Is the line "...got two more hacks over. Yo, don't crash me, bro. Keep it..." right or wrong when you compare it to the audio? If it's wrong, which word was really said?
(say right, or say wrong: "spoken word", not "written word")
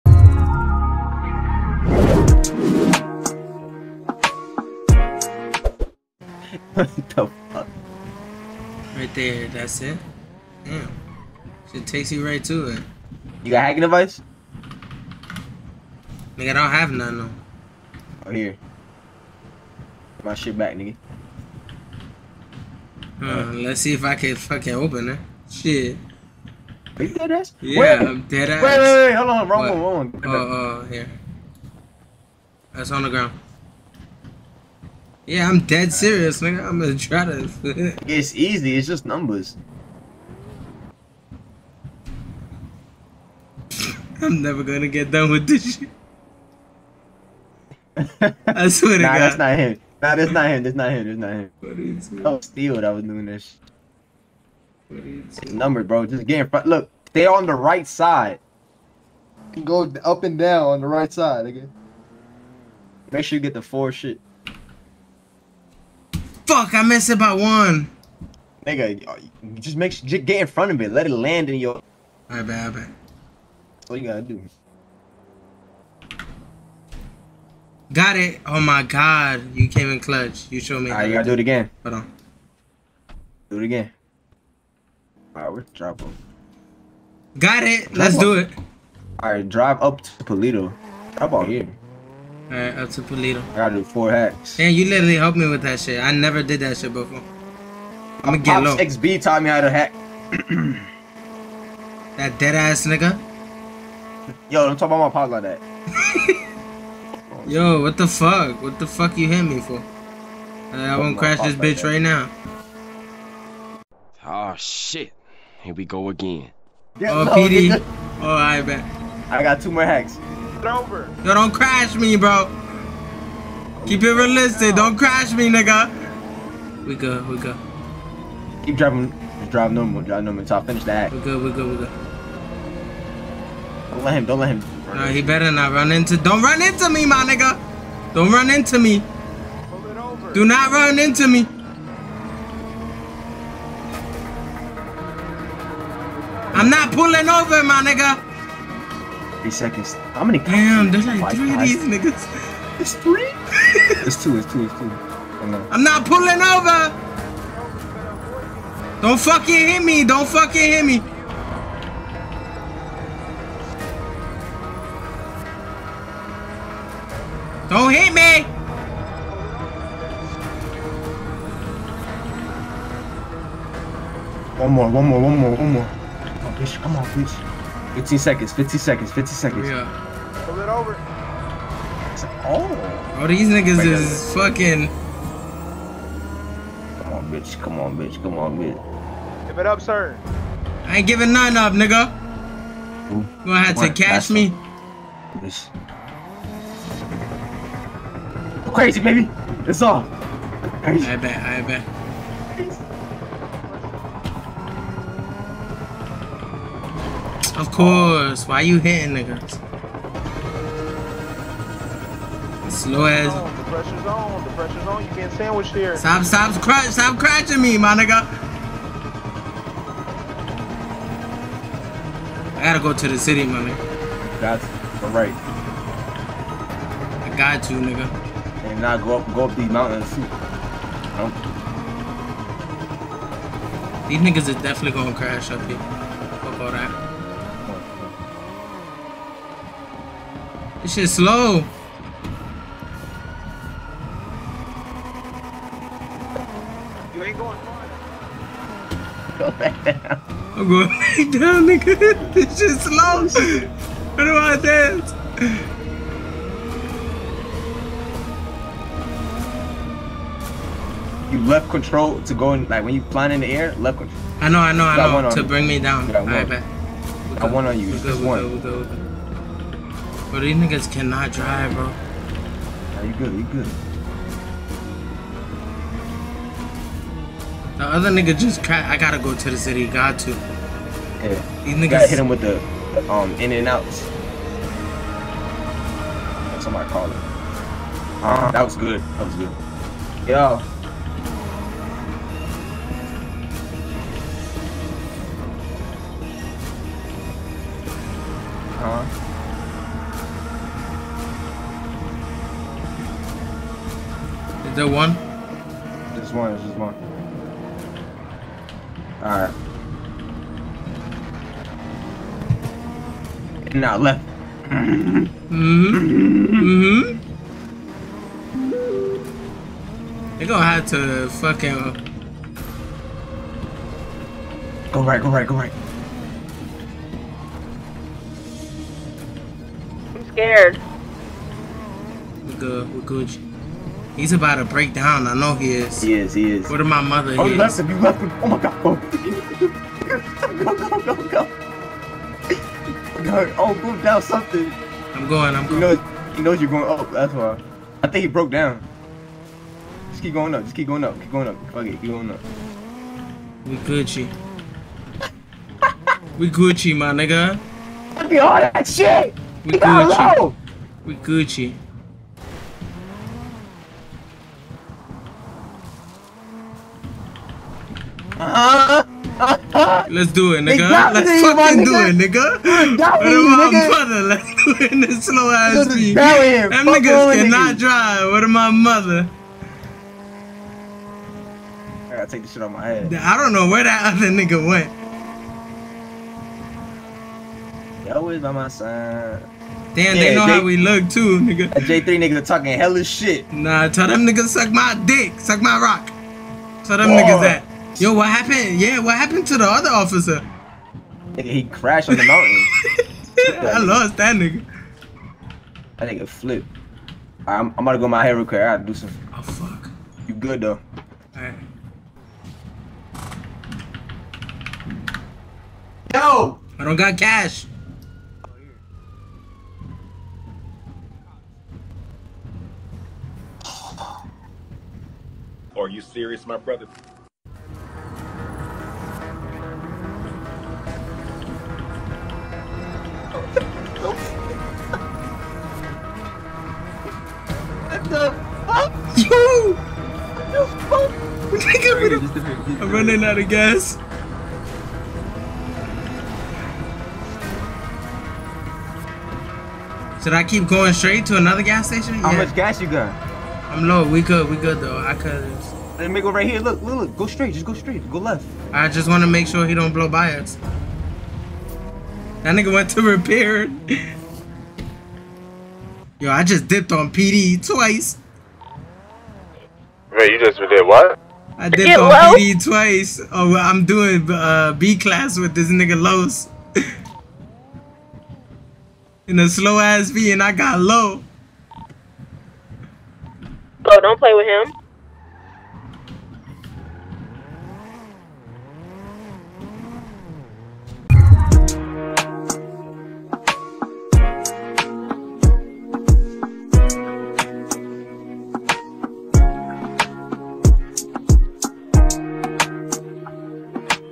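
right.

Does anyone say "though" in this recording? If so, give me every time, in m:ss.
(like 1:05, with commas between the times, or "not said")
0:17, 6:50, 7:34.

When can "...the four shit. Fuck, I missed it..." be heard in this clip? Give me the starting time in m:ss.
1:03.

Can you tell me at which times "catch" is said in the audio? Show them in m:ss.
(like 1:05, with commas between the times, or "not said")
3:13.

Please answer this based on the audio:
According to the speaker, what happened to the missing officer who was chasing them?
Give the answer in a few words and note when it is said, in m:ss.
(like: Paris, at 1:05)
crashed on the mountain, at 6:41.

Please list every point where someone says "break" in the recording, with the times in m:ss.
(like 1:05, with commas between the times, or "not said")
5:34.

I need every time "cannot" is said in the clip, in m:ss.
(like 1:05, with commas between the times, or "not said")
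4:30, 6:17.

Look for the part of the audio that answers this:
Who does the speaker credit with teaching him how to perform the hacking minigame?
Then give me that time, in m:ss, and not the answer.
1:38.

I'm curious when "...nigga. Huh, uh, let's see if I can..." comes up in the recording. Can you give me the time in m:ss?
0:20.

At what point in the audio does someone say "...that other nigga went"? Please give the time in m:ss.
6:23.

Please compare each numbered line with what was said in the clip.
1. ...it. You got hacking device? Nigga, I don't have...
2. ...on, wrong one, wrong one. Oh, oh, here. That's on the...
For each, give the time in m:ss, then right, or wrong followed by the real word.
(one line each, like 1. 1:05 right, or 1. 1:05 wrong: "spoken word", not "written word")
1. 0:12 right
2. 0:29 right.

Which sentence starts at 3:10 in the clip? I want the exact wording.
I ain't giving nothing up, nigga.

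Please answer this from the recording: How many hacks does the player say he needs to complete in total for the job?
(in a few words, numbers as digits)
4.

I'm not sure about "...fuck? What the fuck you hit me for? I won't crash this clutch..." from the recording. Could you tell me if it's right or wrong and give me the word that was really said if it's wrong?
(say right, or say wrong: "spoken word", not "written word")
wrong: "bitch", not "clutch".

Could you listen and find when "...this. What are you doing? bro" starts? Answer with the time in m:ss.
0:53.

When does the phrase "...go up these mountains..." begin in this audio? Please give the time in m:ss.
3:49.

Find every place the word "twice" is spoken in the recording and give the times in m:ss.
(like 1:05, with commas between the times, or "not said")
7:47, 7:52.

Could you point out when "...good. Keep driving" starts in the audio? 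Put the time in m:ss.
2:07.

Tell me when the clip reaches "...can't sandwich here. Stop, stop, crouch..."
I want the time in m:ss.
3:35.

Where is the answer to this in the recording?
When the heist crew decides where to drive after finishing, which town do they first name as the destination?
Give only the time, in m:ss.
1:30.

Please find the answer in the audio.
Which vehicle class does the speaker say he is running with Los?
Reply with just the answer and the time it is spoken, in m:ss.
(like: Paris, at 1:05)
B class, at 7:54.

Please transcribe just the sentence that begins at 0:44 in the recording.
I'm never gonna get done with this shit.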